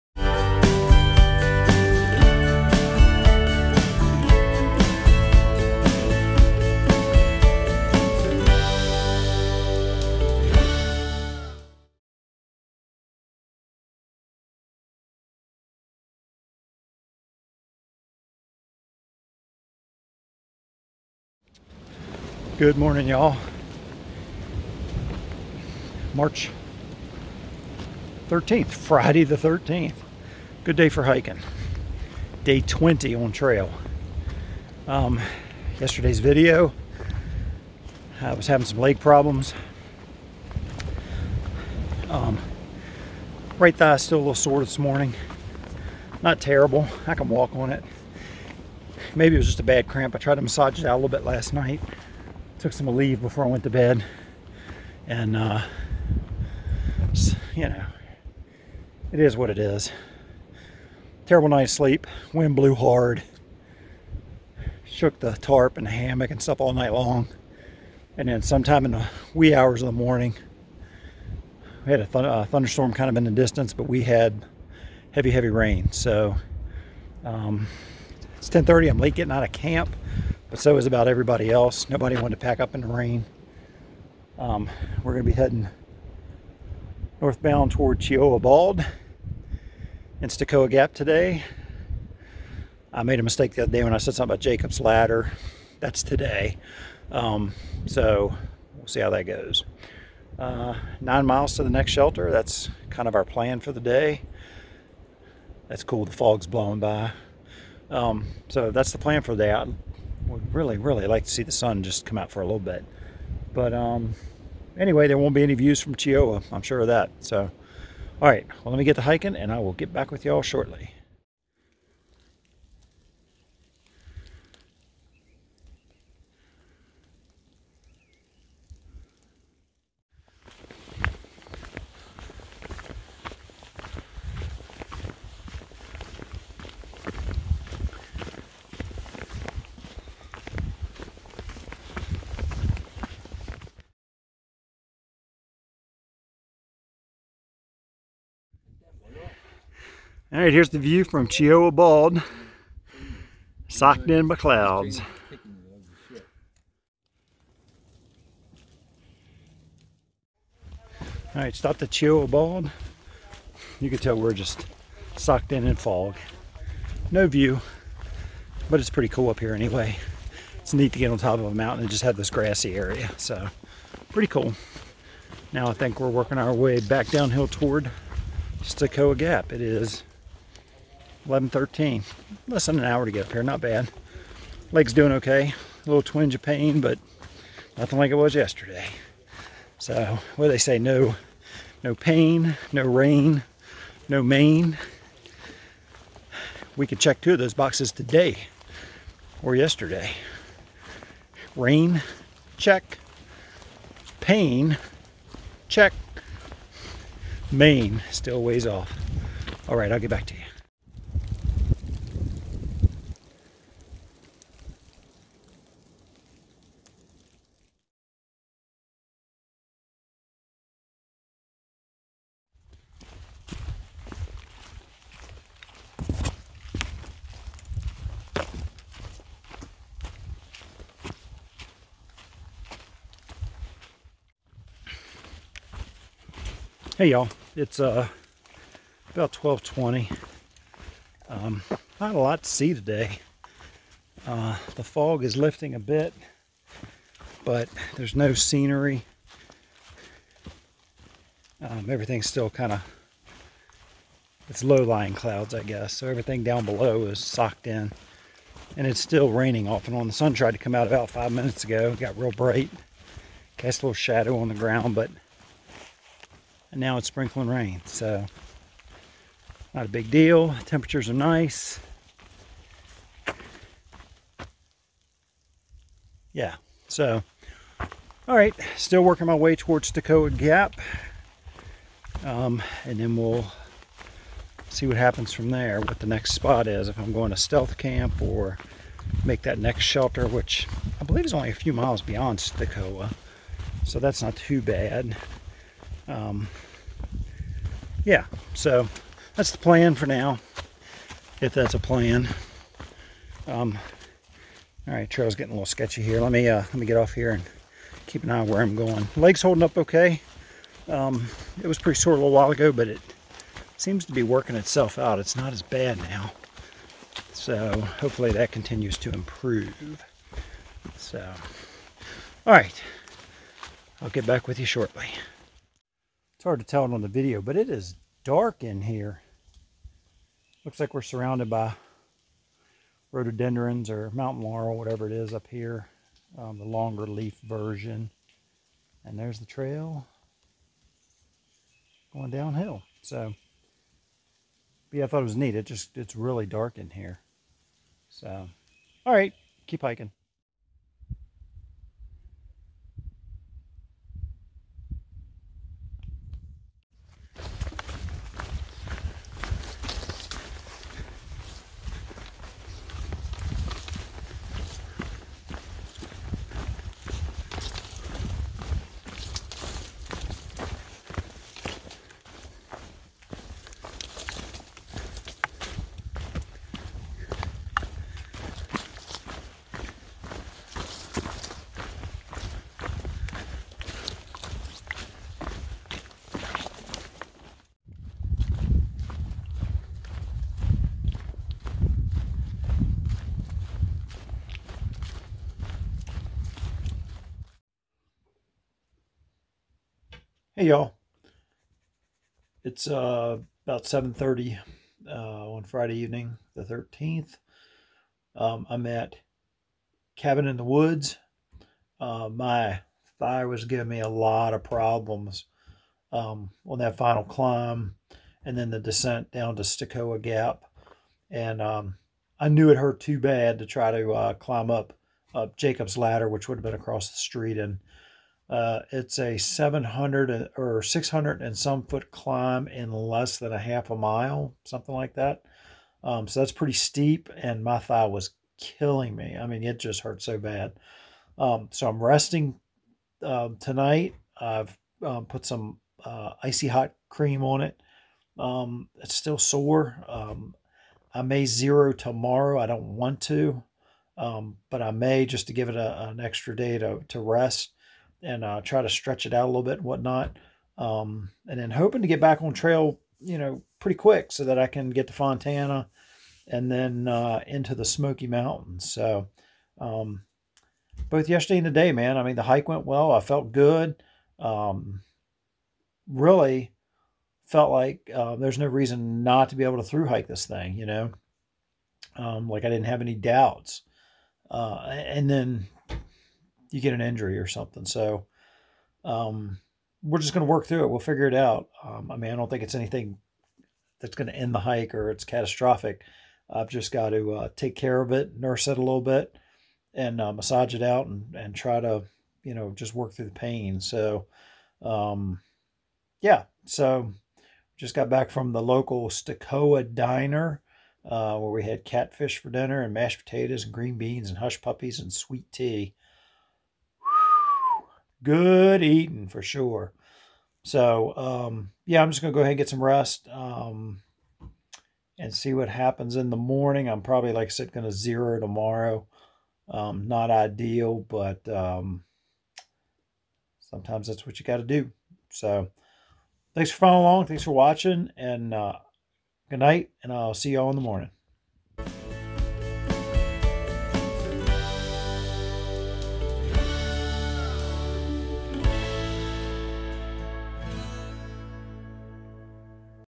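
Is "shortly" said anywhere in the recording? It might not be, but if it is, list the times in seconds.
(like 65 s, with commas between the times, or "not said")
120 s, 324 s.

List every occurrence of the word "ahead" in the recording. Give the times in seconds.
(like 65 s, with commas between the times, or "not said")
522 s.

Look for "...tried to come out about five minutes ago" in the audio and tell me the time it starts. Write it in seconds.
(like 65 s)
260 s.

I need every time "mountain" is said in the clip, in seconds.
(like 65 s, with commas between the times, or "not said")
171 s, 334 s, 468 s.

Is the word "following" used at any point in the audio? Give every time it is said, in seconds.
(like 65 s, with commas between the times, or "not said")
536 s.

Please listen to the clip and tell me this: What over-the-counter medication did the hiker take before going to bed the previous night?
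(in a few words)
Aleve.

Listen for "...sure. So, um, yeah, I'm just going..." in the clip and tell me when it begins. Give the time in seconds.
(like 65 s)
519 s.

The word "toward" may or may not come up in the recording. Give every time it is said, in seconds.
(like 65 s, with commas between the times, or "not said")
87 s, 177 s, 279 s.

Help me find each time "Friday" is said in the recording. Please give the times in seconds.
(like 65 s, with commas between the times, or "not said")
28 s, 405 s.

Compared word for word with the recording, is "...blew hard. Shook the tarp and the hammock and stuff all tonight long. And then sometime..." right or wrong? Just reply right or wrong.
wrong.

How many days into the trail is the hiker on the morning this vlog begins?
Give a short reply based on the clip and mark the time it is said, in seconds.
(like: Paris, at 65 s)
20, at 32 s.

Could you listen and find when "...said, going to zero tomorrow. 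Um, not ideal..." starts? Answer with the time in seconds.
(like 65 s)
527 s.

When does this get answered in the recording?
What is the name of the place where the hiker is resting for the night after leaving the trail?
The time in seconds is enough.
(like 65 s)
410 s.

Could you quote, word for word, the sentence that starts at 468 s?
So, um, both yesterday and today, man, I mean, the hike went well.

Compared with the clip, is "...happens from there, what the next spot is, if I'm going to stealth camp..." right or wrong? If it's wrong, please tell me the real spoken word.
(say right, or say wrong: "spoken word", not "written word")
right.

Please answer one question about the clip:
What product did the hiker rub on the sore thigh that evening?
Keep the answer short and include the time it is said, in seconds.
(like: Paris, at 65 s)
Icy Hot cream, at 446 s.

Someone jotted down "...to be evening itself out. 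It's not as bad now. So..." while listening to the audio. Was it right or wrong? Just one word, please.
wrong.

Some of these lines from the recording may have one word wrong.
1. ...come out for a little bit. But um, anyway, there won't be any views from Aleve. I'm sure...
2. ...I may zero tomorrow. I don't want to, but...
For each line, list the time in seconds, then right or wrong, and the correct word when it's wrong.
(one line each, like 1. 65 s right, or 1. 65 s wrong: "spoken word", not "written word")
1. 112 s wrong: "Cheoah", not "Aleve"
2. 451 s right.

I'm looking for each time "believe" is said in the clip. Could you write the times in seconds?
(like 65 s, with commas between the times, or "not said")
291 s.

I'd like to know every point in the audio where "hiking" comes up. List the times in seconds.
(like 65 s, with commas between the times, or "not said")
31 s, 119 s, 349 s.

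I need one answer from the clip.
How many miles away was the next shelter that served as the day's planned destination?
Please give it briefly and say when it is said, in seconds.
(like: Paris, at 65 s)
9, at 100 s.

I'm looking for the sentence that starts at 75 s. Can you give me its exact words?
So, um, it's 10.30, I'm late getting out of camp, but so is about everybody else.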